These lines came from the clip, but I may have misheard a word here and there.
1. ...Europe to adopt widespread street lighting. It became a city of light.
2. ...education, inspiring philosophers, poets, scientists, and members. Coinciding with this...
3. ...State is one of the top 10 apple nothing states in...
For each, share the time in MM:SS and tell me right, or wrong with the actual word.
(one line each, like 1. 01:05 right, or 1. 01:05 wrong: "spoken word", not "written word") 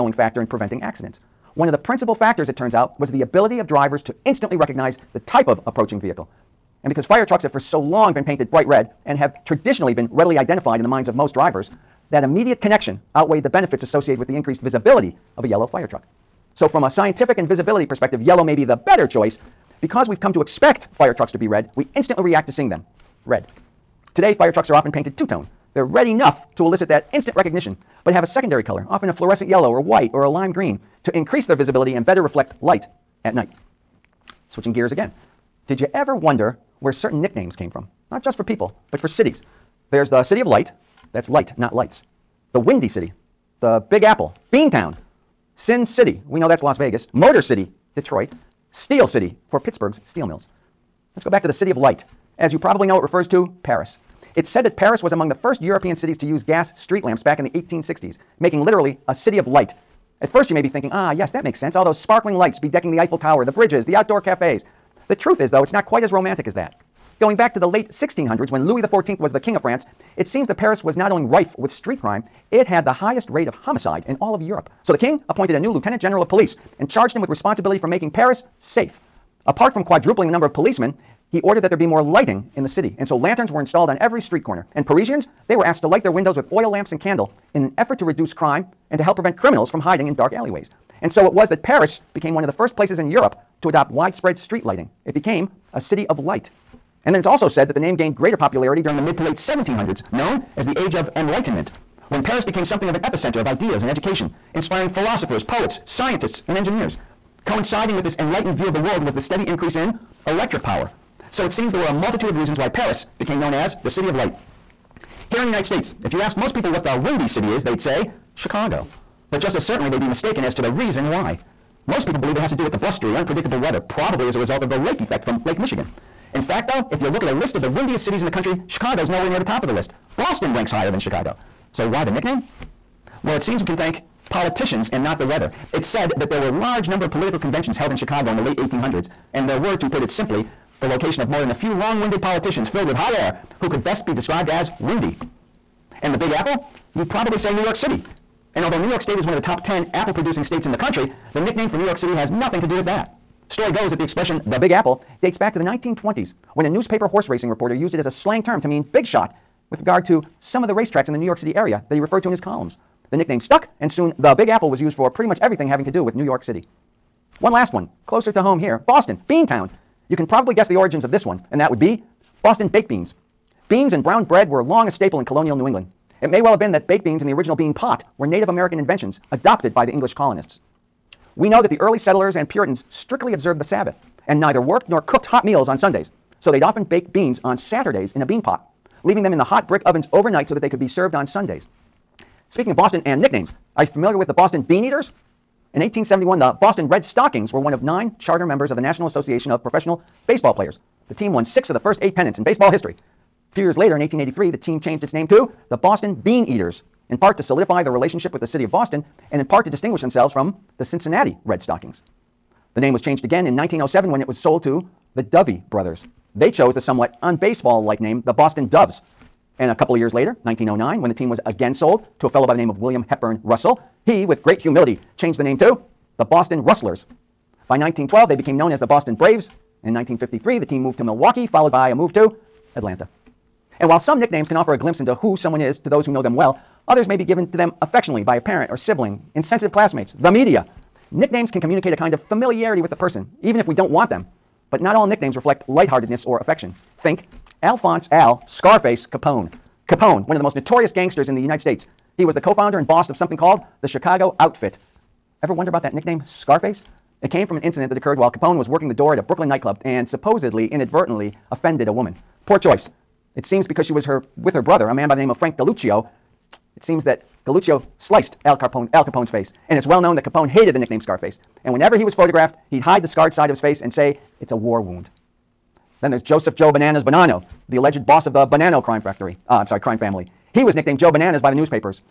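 1. 01:33 right
2. 01:43 wrong: "engineers", not "members"
3. 02:28 wrong: "producing", not "nothing".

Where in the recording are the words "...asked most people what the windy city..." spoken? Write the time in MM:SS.
01:56.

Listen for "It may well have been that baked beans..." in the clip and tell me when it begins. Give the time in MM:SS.
02:56.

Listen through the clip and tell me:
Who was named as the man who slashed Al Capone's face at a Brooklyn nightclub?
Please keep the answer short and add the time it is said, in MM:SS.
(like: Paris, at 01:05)
Frank Galuccio, at 04:25.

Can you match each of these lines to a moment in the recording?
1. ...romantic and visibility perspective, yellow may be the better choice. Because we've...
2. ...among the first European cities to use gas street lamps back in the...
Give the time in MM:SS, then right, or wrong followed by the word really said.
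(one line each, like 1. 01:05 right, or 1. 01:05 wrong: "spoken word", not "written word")
1. 00:16 wrong: "scientific", not "romantic"
2. 00:55 right.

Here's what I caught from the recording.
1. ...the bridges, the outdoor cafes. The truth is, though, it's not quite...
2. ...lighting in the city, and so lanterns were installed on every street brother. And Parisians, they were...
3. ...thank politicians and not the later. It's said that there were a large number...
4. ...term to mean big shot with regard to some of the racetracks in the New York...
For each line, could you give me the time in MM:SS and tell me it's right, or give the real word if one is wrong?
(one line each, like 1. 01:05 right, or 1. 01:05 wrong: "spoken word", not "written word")
1. 01:03 right
2. 01:22 wrong: "corner", not "brother"
3. 02:13 wrong: "weather", not "later"
4. 02:38 right.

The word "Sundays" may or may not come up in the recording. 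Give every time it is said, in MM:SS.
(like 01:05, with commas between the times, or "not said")
03:05, 03:11.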